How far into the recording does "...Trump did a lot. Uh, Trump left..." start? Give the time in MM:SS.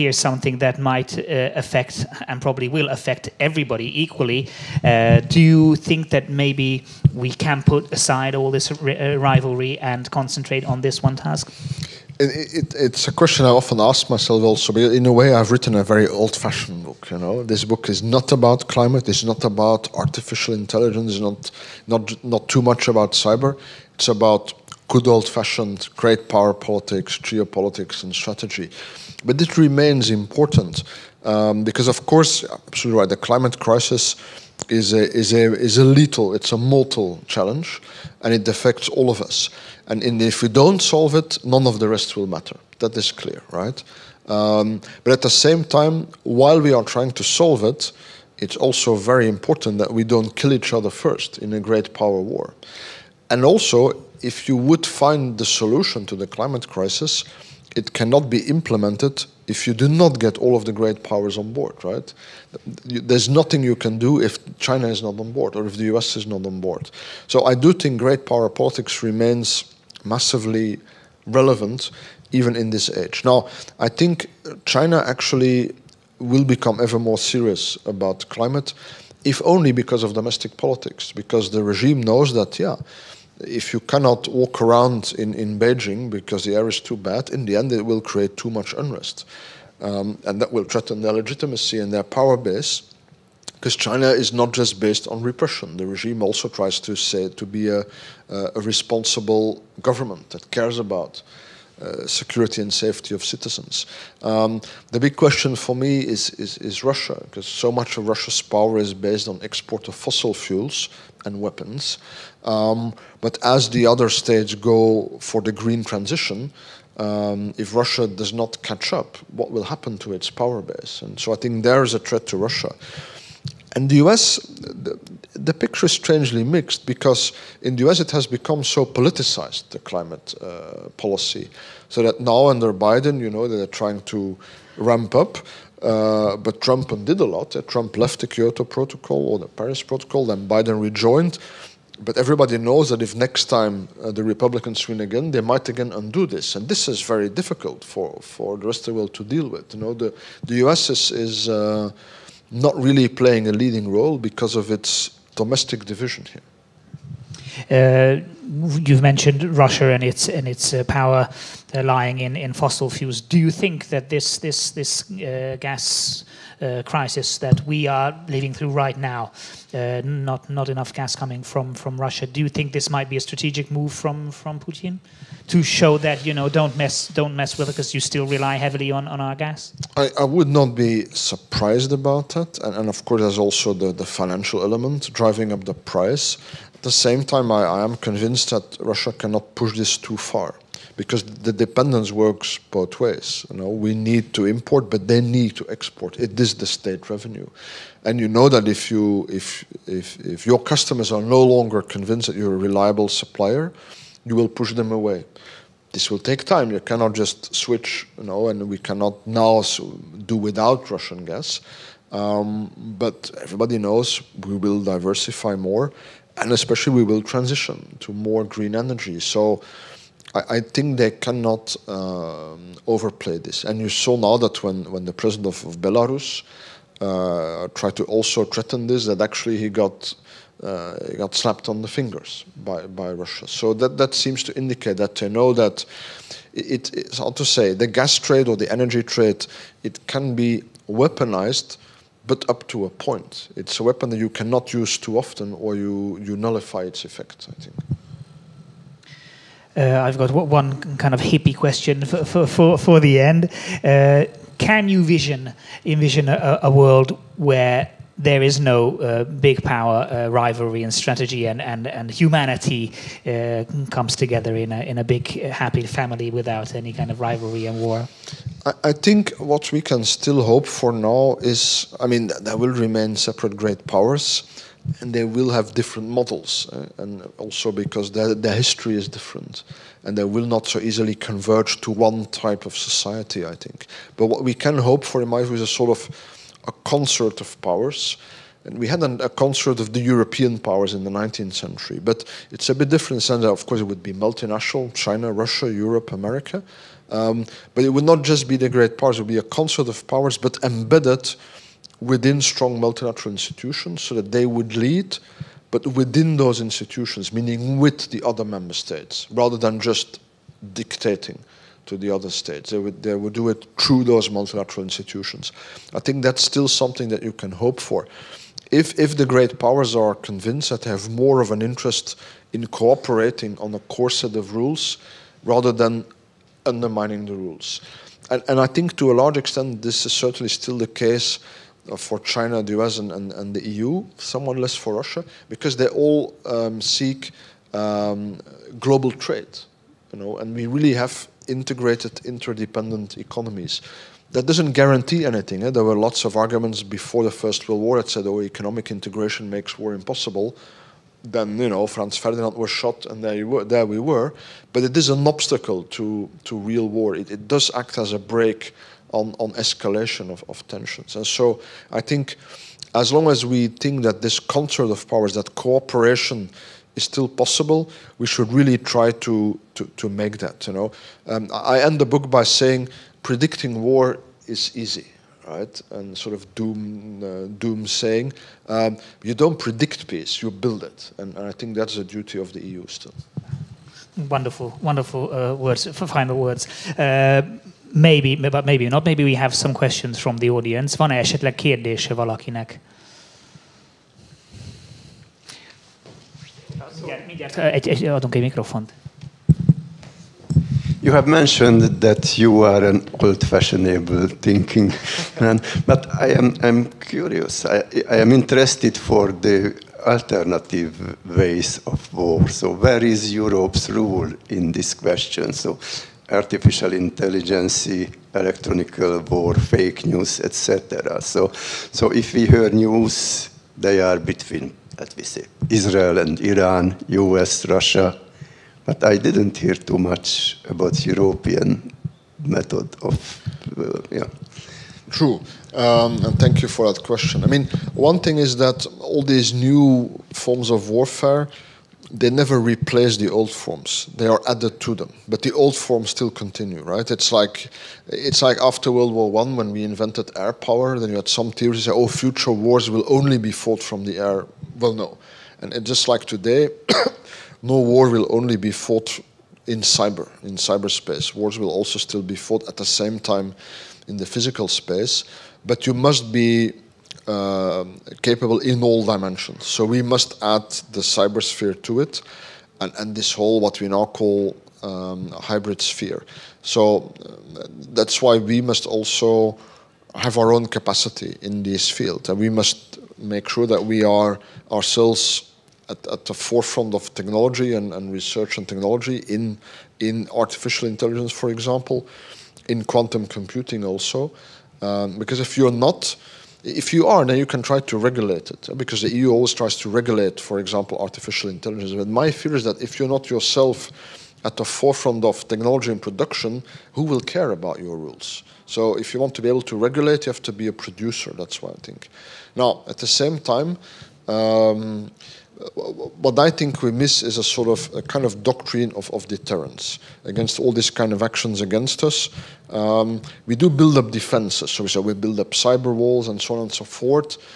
02:16.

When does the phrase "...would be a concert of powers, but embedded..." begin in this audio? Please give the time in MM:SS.
04:59.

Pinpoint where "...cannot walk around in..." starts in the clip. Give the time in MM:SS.
01:23.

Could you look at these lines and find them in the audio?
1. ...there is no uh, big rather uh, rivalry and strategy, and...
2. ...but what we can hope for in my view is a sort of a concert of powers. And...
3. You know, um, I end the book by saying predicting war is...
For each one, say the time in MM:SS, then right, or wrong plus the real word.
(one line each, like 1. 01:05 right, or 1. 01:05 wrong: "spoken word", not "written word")
1. 04:18 wrong: "power", not "rather"
2. 04:44 right
3. 06:10 right.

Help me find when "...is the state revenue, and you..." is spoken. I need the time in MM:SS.
03:16.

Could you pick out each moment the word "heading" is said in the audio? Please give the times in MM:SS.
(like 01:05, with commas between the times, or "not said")
not said.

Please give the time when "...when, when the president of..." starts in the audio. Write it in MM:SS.
03:44.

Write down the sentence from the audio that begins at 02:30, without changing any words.
is, is uh, not really playing a leading role because of its domestic division here.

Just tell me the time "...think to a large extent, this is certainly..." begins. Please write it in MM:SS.
05:28.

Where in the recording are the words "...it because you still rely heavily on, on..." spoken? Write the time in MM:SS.
02:57.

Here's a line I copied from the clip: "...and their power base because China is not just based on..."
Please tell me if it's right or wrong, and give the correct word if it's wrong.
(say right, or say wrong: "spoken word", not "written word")
right.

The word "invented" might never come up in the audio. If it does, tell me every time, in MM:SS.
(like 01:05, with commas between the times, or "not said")
07:29.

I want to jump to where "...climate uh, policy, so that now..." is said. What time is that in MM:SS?
02:09.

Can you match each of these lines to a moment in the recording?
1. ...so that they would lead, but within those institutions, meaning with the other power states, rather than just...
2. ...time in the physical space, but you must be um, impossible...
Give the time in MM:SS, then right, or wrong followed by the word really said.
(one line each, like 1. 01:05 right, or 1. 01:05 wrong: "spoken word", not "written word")
1. 05:04 wrong: "member", not "power"
2. 07:43 wrong: "capable", not "impossible".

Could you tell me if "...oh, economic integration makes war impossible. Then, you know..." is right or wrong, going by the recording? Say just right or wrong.
right.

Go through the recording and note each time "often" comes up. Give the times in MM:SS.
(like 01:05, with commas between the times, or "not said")
00:13, 04:05.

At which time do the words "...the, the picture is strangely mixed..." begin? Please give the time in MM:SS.
02:04.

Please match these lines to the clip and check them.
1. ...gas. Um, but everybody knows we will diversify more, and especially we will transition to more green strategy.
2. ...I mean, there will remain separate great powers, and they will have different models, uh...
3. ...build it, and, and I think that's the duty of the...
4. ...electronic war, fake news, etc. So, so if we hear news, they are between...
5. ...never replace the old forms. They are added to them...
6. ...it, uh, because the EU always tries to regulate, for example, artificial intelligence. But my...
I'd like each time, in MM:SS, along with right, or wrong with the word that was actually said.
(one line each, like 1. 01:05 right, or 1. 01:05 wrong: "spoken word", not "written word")
1. 03:31 wrong: "energy", not "strategy"
2. 04:31 right
3. 06:20 right
4. 06:58 right
5. 07:22 right
6. 08:18 right.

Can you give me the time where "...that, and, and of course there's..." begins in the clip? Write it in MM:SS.
03:02.